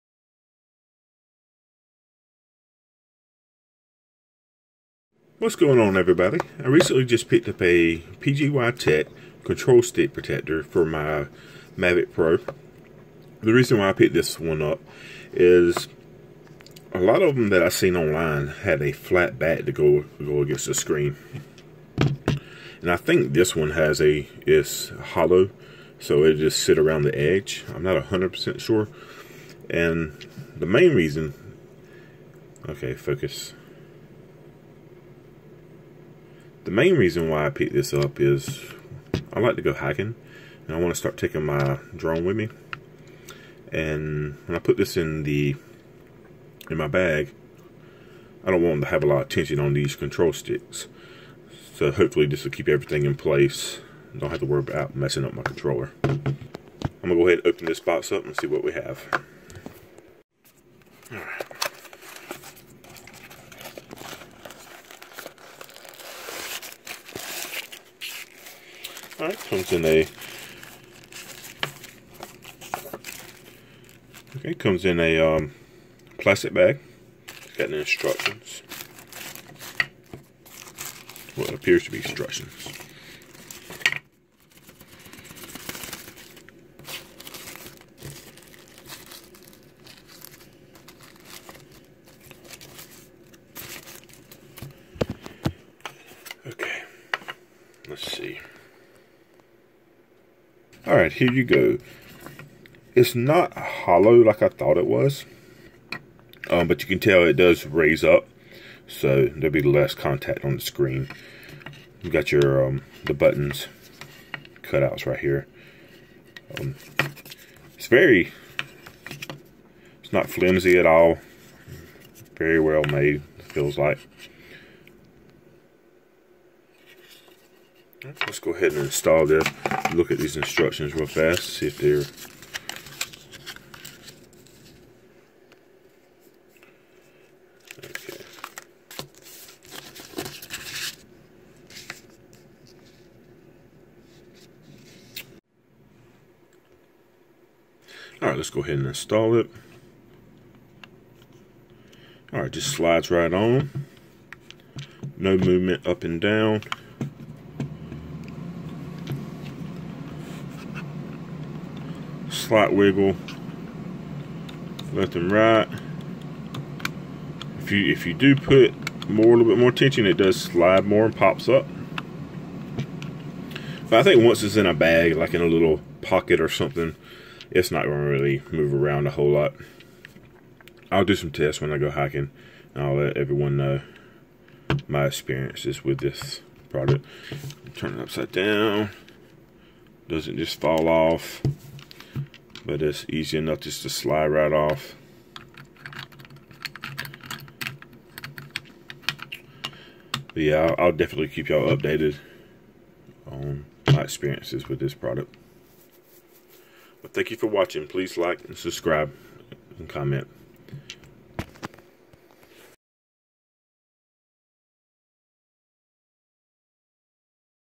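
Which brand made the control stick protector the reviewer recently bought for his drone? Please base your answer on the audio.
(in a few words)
PGY Tech.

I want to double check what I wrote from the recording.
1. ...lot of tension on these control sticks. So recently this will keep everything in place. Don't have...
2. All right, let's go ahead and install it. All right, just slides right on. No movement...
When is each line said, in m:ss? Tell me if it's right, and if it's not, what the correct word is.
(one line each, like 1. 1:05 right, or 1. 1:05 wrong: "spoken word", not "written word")
1. 0:49 wrong: "hopefully", not "recently"
2. 2:28 right.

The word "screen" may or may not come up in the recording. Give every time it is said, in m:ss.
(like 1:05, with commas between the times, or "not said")
0:20, 1:50.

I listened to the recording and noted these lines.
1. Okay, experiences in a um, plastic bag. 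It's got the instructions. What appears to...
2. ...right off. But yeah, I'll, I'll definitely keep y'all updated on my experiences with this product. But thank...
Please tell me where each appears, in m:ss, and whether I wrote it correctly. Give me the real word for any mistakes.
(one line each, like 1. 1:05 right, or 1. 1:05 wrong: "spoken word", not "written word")
1. 1:14 wrong: "comes", not "experiences"
2. 3:14 right.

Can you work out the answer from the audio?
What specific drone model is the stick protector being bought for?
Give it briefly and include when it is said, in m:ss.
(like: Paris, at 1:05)
Mavic Pro, at 0:11.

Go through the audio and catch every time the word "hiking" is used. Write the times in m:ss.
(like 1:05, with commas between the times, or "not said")
0:39, 3:01.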